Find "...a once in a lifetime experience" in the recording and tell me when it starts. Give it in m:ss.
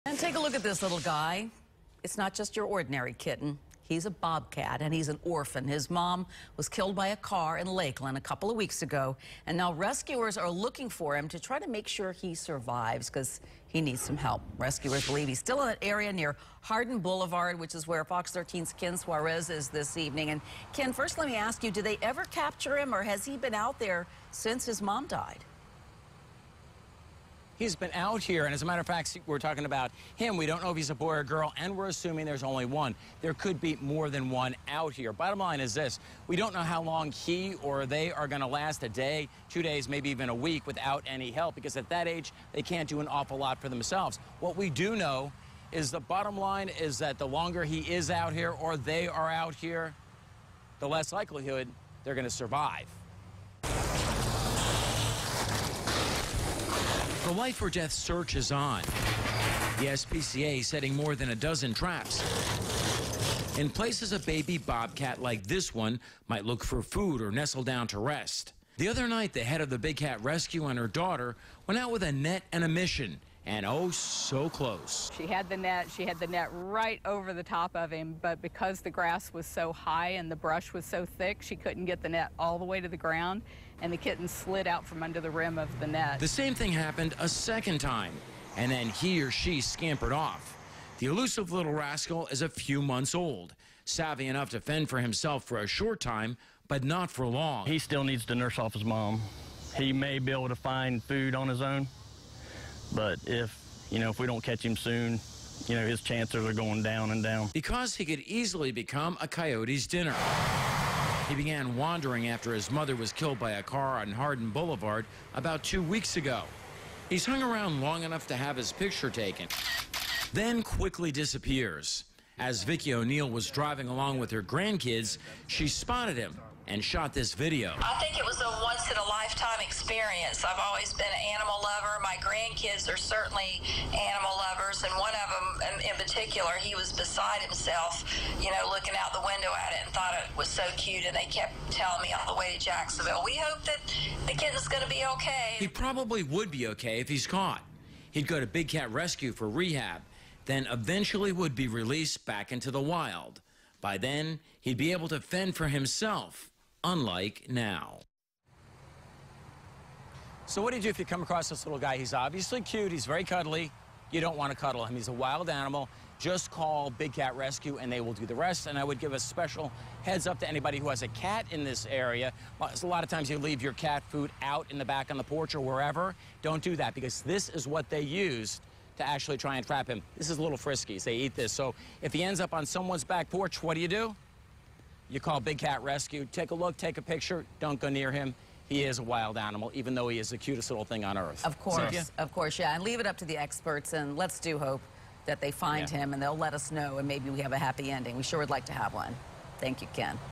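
2:08.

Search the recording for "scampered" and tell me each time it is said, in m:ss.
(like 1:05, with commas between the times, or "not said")
1:29.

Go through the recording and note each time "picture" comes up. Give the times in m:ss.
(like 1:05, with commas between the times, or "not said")
1:58, 3:07.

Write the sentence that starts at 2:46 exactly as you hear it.
Just call Big Cat Rescue, and they will do the rest.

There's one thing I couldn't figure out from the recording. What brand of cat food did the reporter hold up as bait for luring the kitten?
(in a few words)
Friskies.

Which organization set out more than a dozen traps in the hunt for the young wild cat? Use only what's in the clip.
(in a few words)
SPCA.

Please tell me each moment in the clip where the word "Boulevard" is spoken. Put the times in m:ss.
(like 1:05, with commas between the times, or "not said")
0:16, 1:54.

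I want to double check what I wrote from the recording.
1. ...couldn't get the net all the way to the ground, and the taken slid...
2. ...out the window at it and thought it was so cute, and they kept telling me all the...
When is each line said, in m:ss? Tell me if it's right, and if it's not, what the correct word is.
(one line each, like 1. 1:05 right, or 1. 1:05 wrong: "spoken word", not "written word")
1. 1:21 wrong: "kitten", not "taken"
2. 2:18 right.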